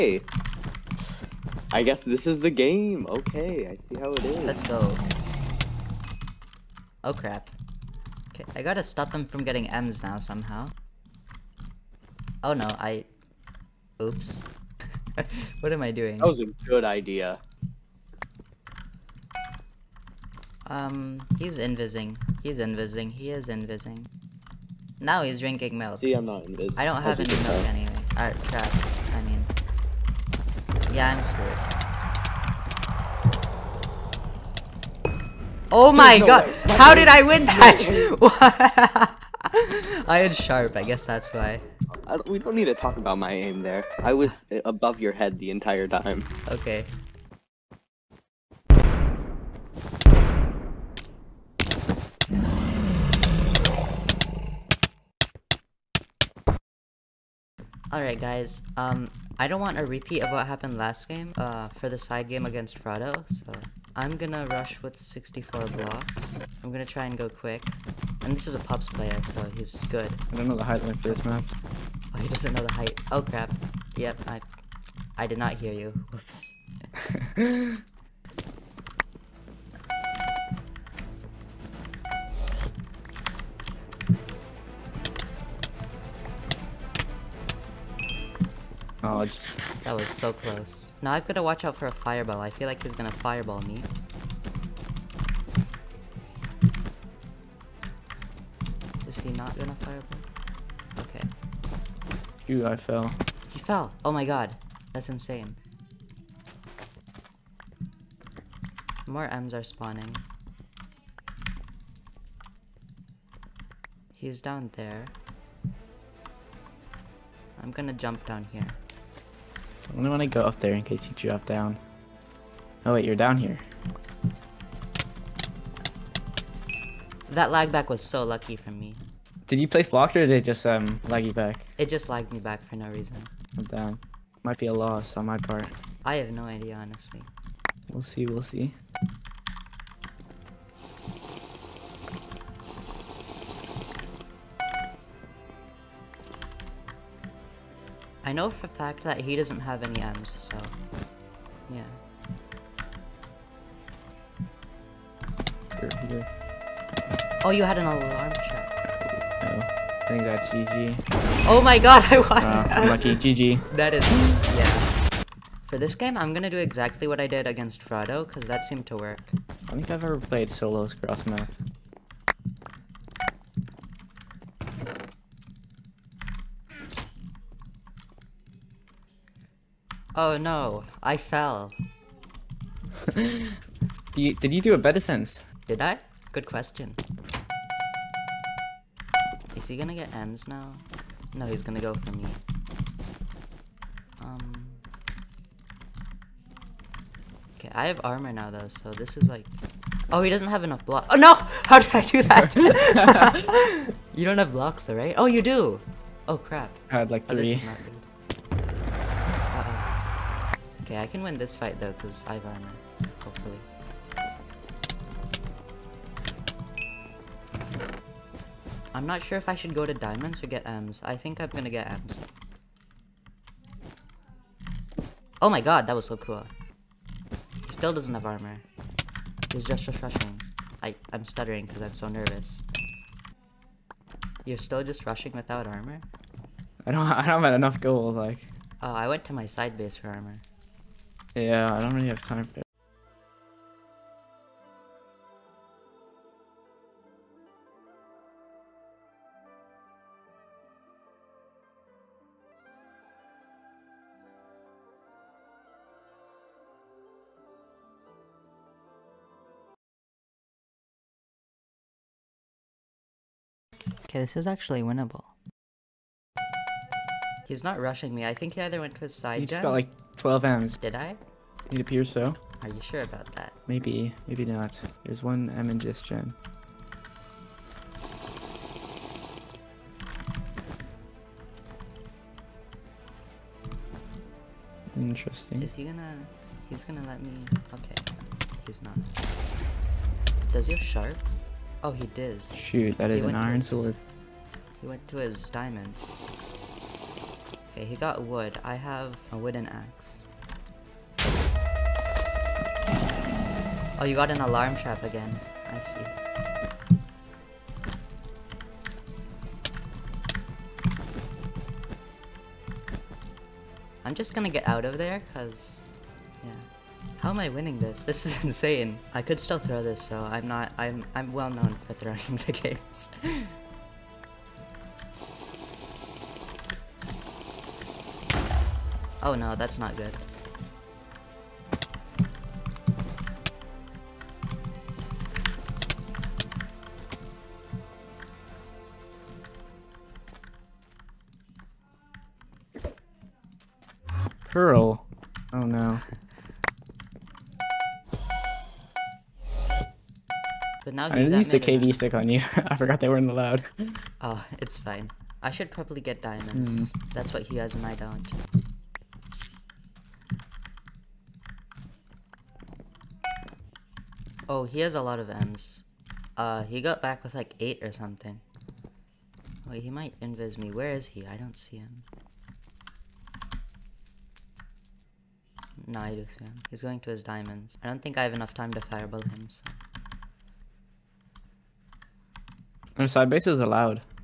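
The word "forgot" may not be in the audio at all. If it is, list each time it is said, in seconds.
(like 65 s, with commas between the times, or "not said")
352 s.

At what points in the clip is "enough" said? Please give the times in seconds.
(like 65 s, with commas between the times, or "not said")
200 s, 237 s, 378 s.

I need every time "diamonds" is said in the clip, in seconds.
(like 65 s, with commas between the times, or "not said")
219 s, 295 s, 356 s, 377 s.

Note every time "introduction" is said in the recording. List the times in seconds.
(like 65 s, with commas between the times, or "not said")
not said.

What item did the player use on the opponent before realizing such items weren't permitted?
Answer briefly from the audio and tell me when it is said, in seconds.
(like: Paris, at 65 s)
KB stick, at 351 s.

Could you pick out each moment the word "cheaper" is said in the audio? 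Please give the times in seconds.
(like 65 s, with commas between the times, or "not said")
not said.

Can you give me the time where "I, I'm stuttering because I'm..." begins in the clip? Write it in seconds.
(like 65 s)
230 s.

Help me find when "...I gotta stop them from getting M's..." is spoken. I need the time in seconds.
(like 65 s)
8 s.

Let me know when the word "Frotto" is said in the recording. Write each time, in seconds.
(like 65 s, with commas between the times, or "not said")
62 s, 167 s.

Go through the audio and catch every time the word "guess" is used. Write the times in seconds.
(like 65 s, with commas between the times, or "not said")
1 s, 40 s.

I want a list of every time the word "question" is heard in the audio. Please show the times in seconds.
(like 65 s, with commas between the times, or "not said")
186 s.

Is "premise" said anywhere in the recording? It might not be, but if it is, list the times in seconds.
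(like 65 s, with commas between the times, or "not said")
not said.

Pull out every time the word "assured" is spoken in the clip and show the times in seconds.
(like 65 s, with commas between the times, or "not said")
not said.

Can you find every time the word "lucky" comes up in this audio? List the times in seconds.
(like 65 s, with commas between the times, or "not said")
128 s, 162 s.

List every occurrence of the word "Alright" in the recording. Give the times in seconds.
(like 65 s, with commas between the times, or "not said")
28 s, 57 s.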